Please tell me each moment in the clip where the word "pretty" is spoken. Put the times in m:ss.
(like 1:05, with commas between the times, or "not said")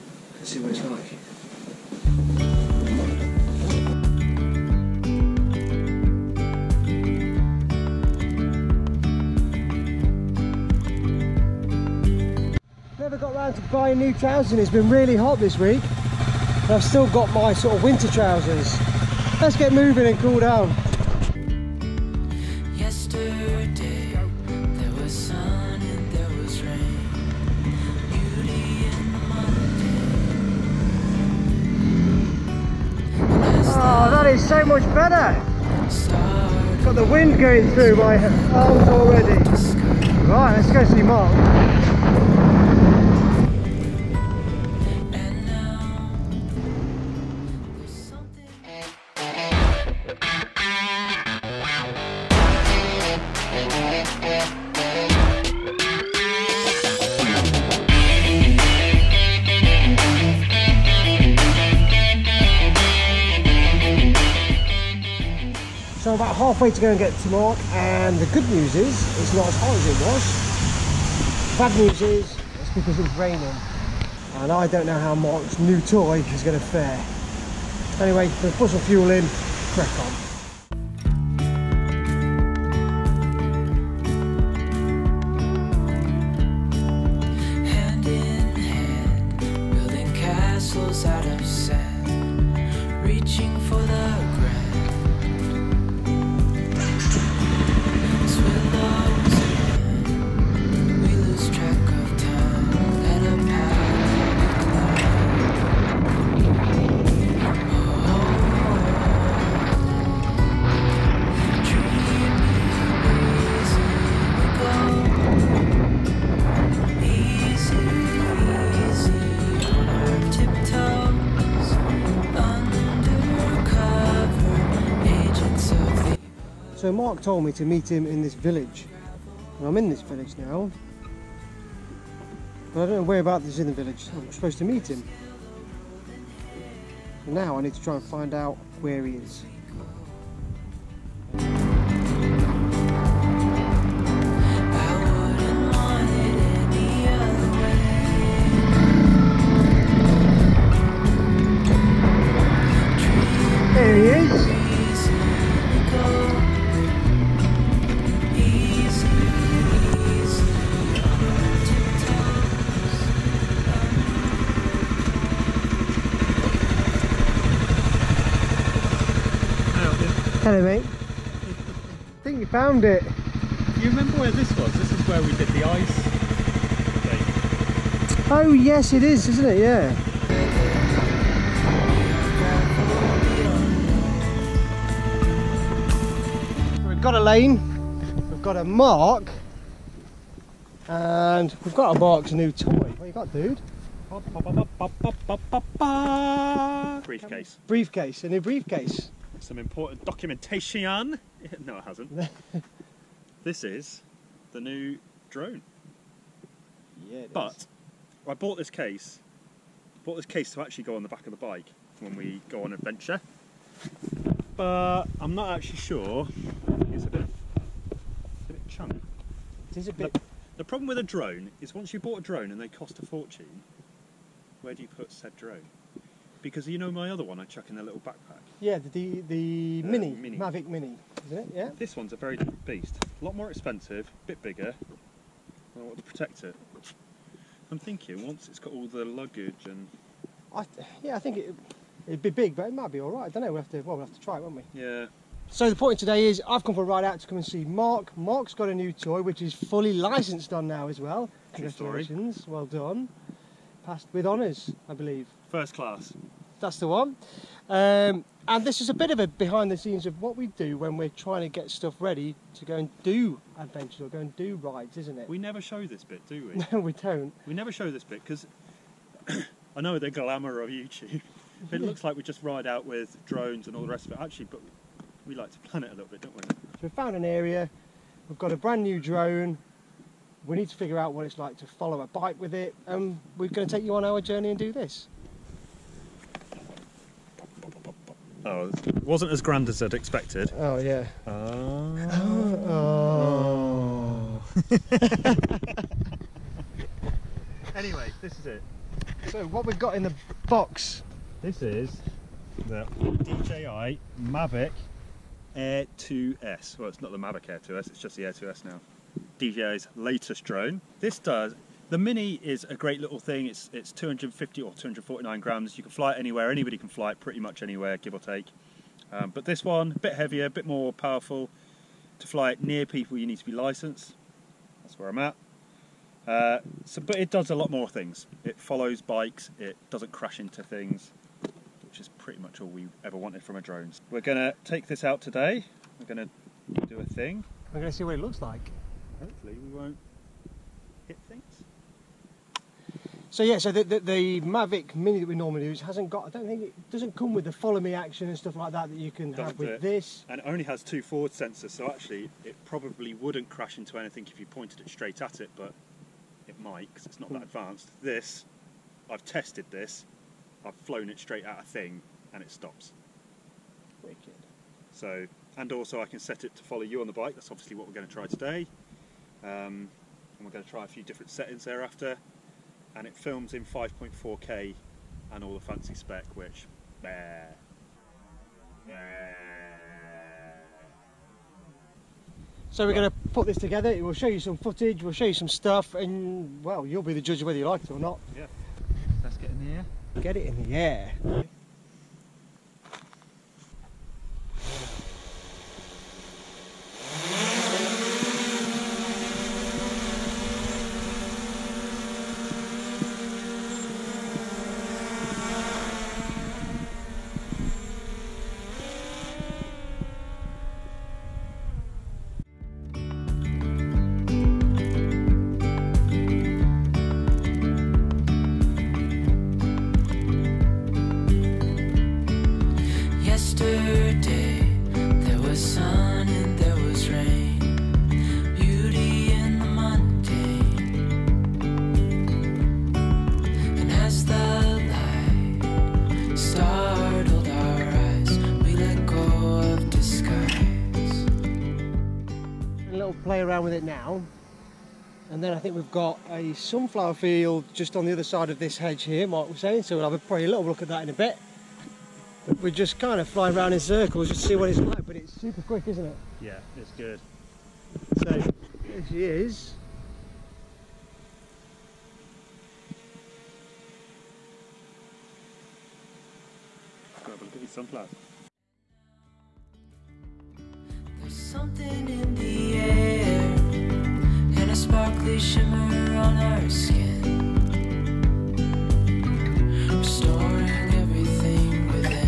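5:17, 5:32, 7:30.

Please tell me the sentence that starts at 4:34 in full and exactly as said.
Actually, but we like to plan it a little bit, don't we?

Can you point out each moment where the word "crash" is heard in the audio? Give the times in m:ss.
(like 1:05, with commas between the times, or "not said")
5:30, 5:53.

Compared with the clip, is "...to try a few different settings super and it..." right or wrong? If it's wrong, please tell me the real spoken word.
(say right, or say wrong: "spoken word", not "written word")
wrong: "thereafter", not "super".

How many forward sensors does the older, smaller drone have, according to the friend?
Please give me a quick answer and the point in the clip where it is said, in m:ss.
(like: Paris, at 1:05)
2, at 5:50.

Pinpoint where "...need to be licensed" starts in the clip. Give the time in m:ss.
5:23.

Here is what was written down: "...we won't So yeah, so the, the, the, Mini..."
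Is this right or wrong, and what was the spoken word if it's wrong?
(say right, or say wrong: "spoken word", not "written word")
wrong: "Mavic", not "Mini".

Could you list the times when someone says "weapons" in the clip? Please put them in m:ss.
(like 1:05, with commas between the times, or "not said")
not said.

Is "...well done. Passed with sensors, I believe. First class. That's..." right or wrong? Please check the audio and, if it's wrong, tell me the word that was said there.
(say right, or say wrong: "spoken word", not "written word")
wrong: "honours", not "sensors".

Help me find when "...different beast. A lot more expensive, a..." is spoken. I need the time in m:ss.
3:52.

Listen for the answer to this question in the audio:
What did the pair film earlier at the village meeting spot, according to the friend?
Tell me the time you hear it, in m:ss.
2:55.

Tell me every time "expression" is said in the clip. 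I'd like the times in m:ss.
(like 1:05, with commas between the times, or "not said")
not said.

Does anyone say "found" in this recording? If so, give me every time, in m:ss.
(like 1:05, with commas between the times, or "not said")
2:52, 4:36.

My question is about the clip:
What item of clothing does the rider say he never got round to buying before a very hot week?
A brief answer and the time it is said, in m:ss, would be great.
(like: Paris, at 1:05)
new trousers, at 0:13.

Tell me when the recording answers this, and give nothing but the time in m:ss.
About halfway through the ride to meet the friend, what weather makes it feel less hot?
1:13.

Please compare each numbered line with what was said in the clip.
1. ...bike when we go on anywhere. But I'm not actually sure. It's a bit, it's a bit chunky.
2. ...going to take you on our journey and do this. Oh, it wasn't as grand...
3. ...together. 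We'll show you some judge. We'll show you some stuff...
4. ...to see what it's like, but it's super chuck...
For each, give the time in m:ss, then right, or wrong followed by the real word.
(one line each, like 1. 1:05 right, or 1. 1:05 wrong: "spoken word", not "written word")
1. 3:31 wrong: "adventure", not "anywhere"
2. 4:43 right
3. 6:23 wrong: "footage", not "judge"
4. 7:34 wrong: "quick", not "chuck".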